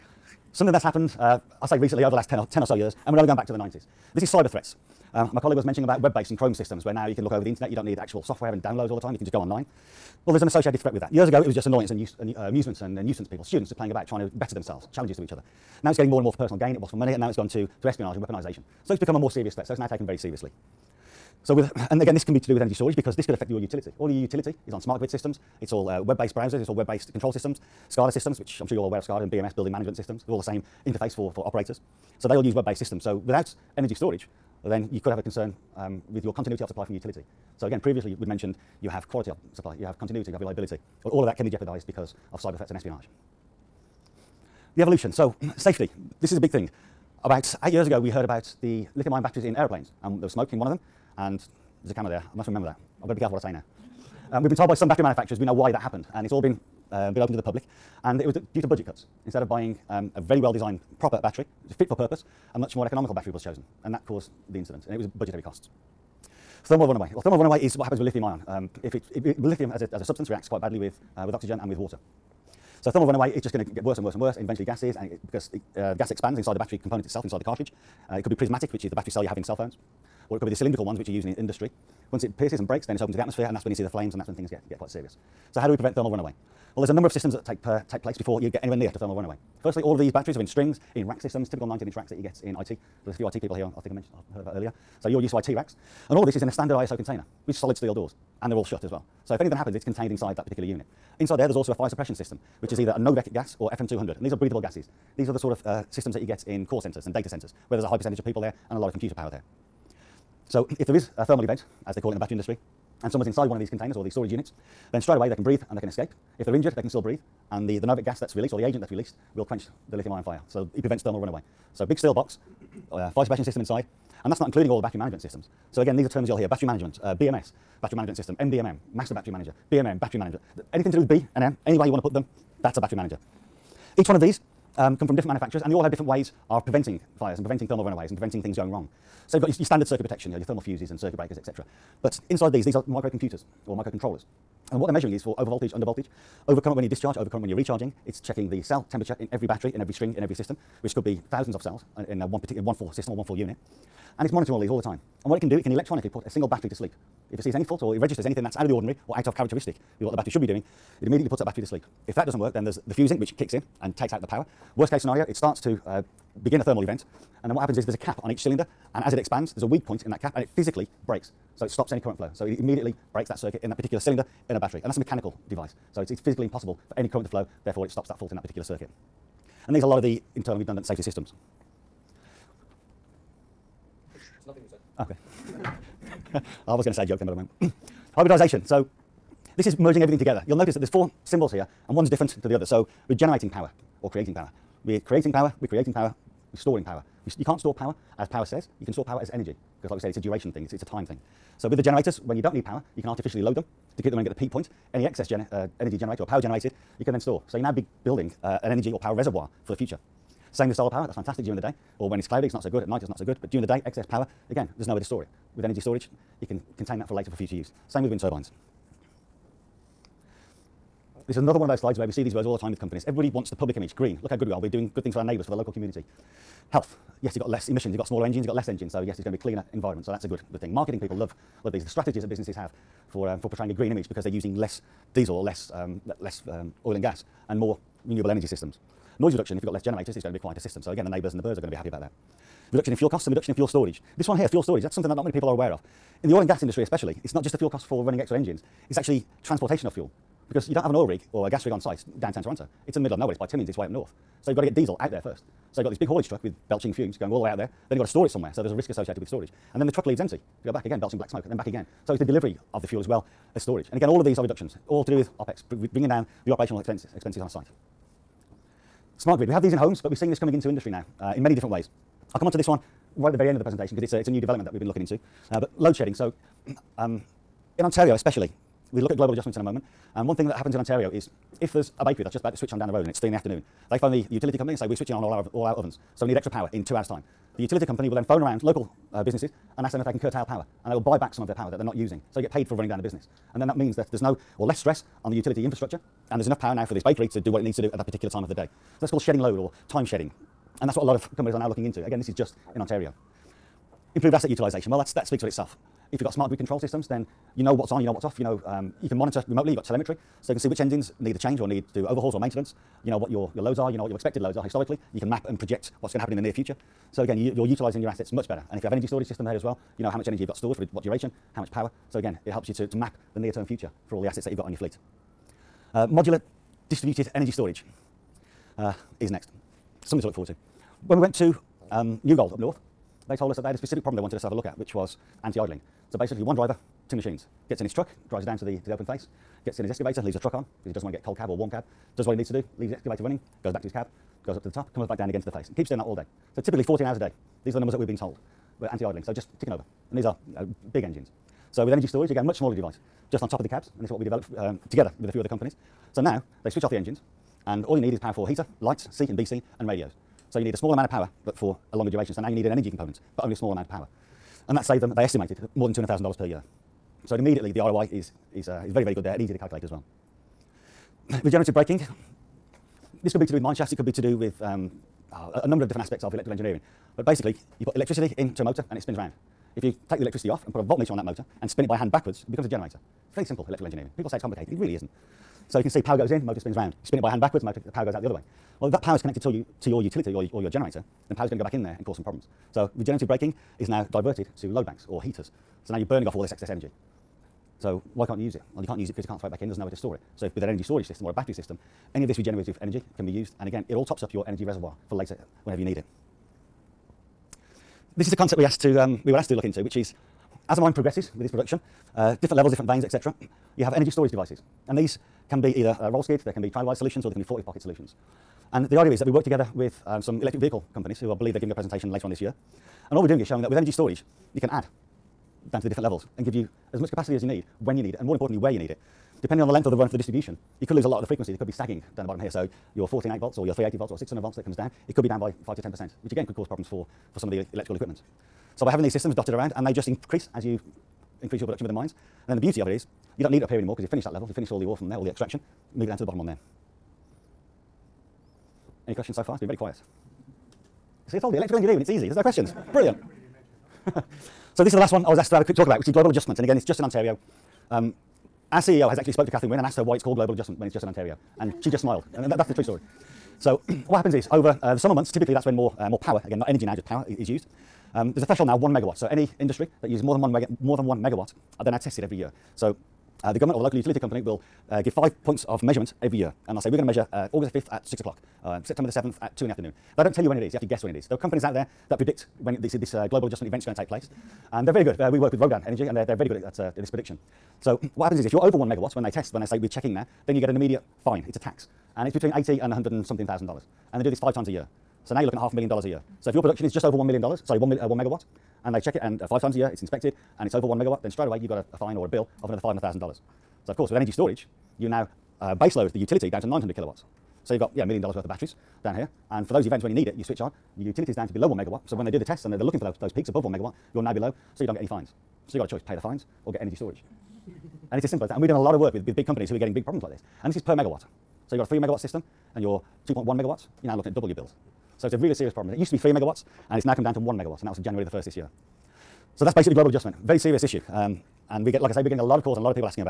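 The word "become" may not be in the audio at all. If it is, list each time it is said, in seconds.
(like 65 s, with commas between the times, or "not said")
18 s, 382 s.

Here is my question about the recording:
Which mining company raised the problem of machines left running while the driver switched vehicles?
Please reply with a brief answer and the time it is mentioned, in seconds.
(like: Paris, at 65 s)
New Gold, at 332 s.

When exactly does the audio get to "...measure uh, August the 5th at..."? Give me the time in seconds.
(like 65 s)
477 s.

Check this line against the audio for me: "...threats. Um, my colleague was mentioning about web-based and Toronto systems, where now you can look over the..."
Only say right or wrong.
wrong.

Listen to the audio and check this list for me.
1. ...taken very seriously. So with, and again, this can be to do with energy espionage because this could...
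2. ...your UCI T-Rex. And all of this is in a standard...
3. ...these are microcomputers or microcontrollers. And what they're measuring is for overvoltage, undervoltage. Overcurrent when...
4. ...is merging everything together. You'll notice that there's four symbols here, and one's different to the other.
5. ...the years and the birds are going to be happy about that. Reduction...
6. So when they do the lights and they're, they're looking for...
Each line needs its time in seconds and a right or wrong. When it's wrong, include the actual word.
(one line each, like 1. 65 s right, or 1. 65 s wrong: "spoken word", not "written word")
1. 19 s wrong: "storage", not "espionage"
2. 95 s right
3. 142 s right
4. 189 s right
5. 241 s wrong: "neighbours", not "years"
6. 512 s wrong: "tests", not "lights".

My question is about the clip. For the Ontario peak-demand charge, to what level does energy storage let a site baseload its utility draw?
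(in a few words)
900 kilowatts.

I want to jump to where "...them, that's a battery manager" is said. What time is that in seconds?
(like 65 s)
132 s.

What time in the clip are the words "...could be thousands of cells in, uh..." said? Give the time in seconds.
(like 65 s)
150 s.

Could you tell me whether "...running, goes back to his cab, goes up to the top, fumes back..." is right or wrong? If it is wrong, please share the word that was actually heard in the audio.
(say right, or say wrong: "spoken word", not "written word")
wrong: "comes", not "fumes".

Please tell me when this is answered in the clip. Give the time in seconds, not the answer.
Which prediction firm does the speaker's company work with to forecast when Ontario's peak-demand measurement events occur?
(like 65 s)
485 s.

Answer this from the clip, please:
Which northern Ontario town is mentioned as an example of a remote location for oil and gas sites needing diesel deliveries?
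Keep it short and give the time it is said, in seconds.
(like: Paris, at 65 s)
Timmins, at 253 s.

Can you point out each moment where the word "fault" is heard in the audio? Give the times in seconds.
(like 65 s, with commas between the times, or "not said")
157 s, 178 s.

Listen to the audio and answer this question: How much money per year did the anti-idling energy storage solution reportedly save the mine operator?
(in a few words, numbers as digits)
more than $200,000.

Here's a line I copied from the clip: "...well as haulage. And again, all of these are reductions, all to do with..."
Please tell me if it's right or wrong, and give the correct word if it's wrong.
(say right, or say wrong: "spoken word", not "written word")
wrong: "storage", not "haulage".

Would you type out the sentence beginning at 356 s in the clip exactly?
So now they switch off the engines and all you need is power for heater, lights, C and BC, and radios.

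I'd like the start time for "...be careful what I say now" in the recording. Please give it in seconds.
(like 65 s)
53 s.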